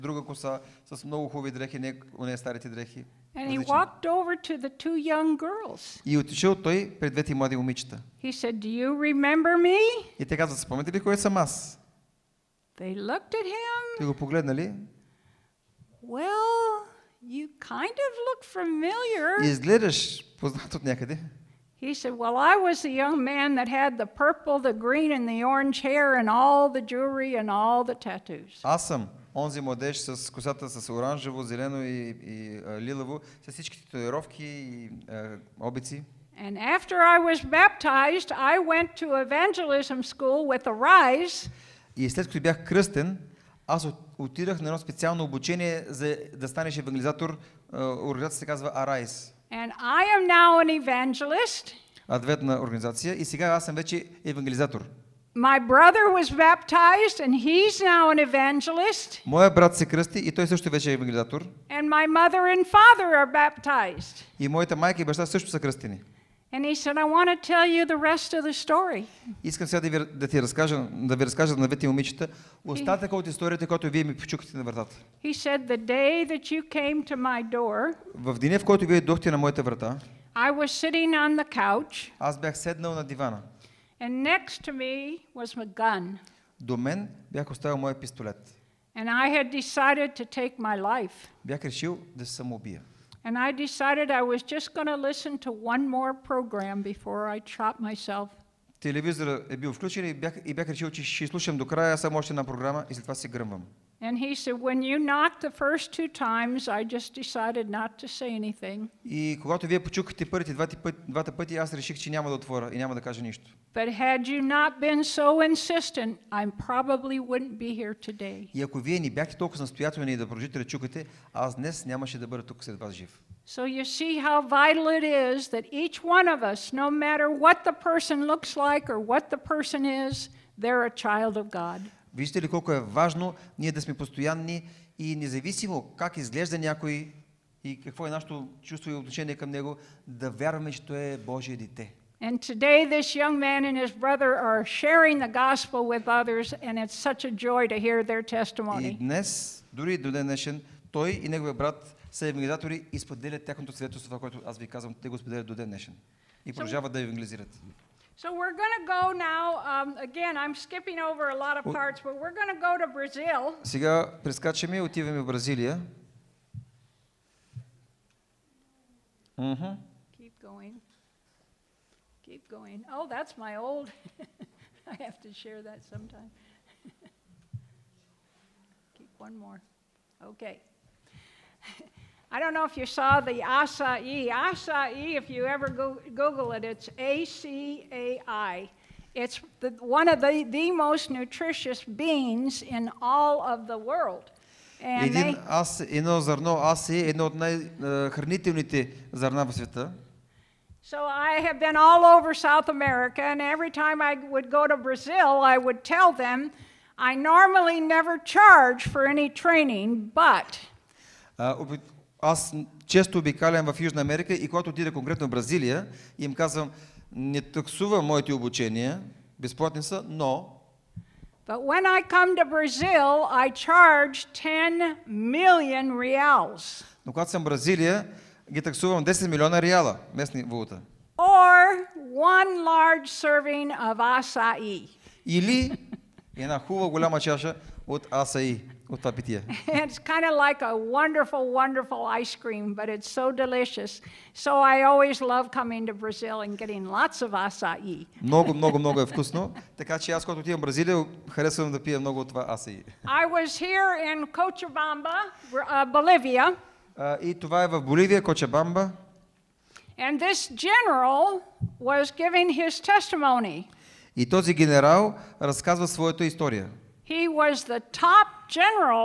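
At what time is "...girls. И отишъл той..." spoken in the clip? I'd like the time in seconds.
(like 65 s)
5 s.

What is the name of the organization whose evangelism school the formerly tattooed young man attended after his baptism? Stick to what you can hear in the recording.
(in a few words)
ARISE.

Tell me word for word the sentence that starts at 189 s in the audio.
It's the, one of the, the most nutritious beans in all of the world.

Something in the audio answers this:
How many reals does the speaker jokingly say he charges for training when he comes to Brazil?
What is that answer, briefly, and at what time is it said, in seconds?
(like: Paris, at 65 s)
10 million, at 224 s.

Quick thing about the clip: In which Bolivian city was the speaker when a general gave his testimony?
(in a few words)
Cochabamba.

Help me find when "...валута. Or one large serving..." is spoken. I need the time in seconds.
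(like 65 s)
230 s.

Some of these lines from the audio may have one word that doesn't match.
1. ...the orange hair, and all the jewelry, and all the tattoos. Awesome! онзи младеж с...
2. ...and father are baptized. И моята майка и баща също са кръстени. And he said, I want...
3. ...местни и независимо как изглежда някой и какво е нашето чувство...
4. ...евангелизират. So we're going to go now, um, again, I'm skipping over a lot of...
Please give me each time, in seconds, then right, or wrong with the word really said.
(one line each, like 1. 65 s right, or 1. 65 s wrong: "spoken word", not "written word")
1. 25 s right
2. 62 s right
3. 133 s wrong: "постоянни", not "местни"
4. 157 s right.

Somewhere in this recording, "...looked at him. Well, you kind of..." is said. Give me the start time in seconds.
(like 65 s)
12 s.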